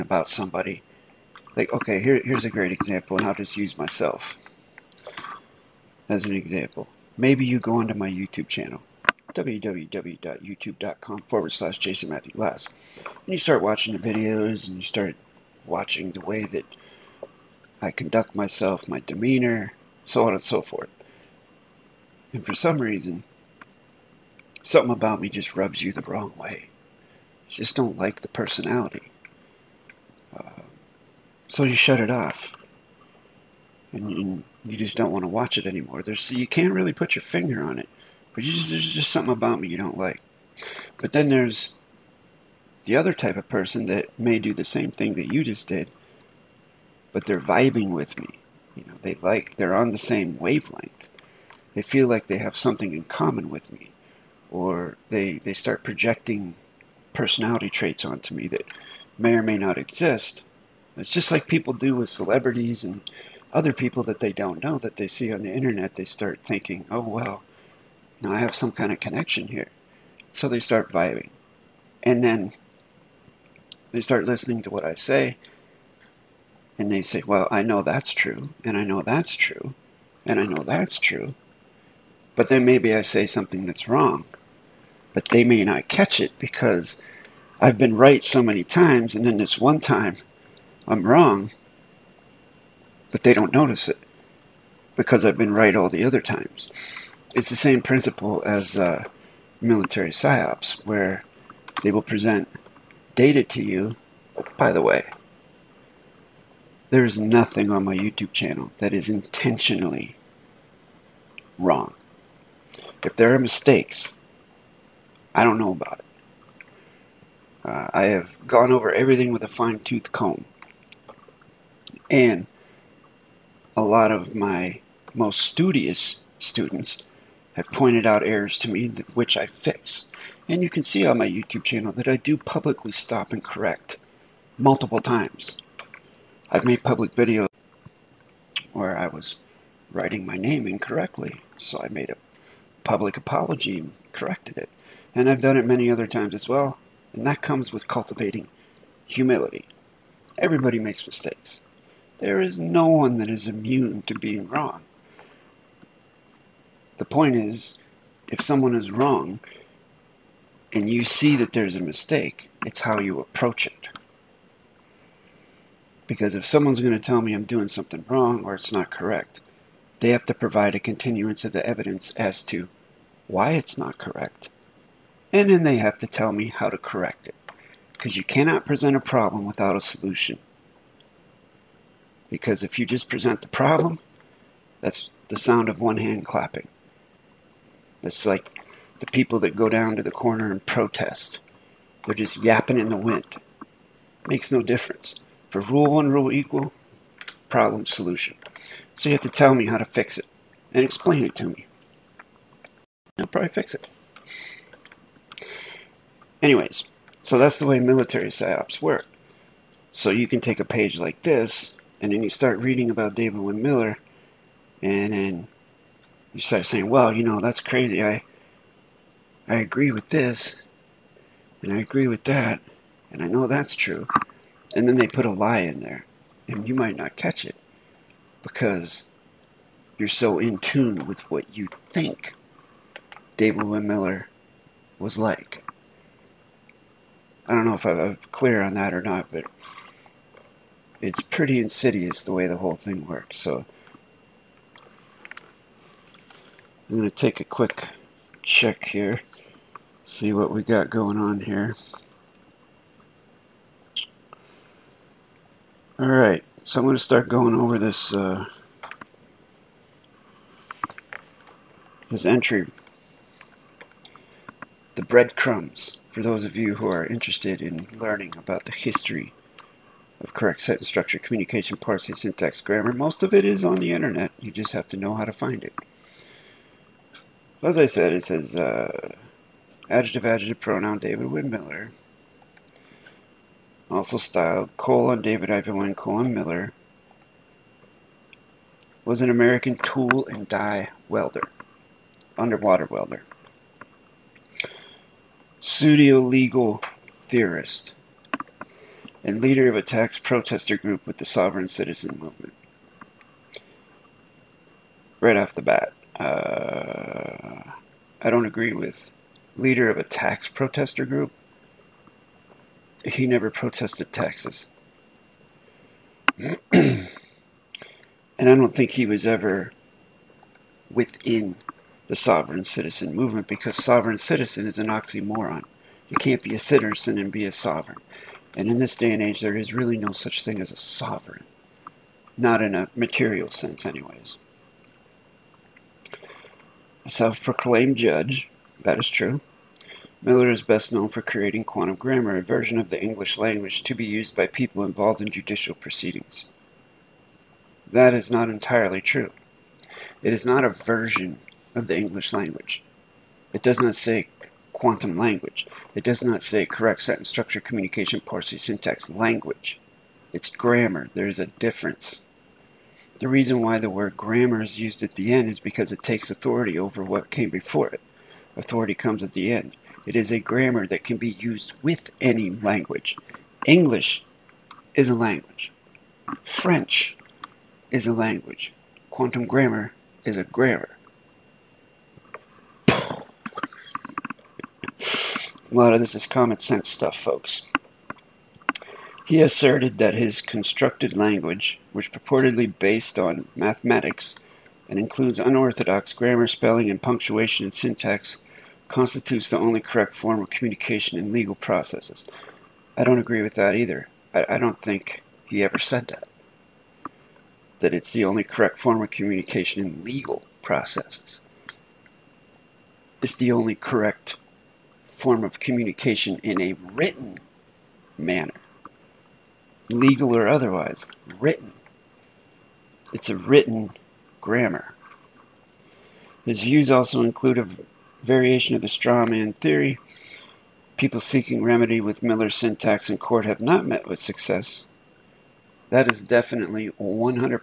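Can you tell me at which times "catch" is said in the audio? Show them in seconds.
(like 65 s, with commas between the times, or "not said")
85 s, 227 s.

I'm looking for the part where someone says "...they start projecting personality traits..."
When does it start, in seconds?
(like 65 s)
55 s.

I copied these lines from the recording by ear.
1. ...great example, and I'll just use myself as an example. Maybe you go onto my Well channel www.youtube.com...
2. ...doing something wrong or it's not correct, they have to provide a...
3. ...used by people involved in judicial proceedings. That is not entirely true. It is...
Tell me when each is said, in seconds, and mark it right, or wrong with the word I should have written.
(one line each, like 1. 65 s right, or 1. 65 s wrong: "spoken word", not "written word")
1. 2 s wrong: "YouTube", not "Well"
2. 167 s right
3. 344 s right.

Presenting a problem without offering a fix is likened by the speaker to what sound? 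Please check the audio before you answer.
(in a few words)
one hand clapping.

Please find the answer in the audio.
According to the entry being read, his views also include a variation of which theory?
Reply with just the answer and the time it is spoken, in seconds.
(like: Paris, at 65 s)
straw man theory, at 428 s.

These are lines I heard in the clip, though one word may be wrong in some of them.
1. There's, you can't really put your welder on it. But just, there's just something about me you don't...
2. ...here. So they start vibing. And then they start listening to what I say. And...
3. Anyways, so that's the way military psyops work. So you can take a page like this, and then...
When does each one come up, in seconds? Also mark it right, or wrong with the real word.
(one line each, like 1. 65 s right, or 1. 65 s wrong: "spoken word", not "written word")
1. 36 s wrong: "finger", not "welder"
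2. 69 s right
3. 206 s right.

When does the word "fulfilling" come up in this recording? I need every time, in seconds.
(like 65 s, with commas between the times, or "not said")
not said.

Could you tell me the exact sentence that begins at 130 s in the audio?
And you can see on my YouTube channel that I do publicly stop and correct multiple times.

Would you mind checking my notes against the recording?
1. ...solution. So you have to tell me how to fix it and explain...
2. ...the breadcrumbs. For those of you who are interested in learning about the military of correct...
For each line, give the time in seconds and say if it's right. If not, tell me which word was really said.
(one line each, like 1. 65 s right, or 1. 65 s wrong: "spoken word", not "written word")
1. 197 s right
2. 264 s wrong: "history", not "military".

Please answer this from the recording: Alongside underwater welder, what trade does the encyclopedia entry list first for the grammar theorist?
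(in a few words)
tool and die welder.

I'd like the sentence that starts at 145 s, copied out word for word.
And I've done it many other times as well, and that comes with cultivating humility.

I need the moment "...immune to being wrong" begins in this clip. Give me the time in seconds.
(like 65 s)
153 s.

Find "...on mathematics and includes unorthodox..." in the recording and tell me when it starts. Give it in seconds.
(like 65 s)
393 s.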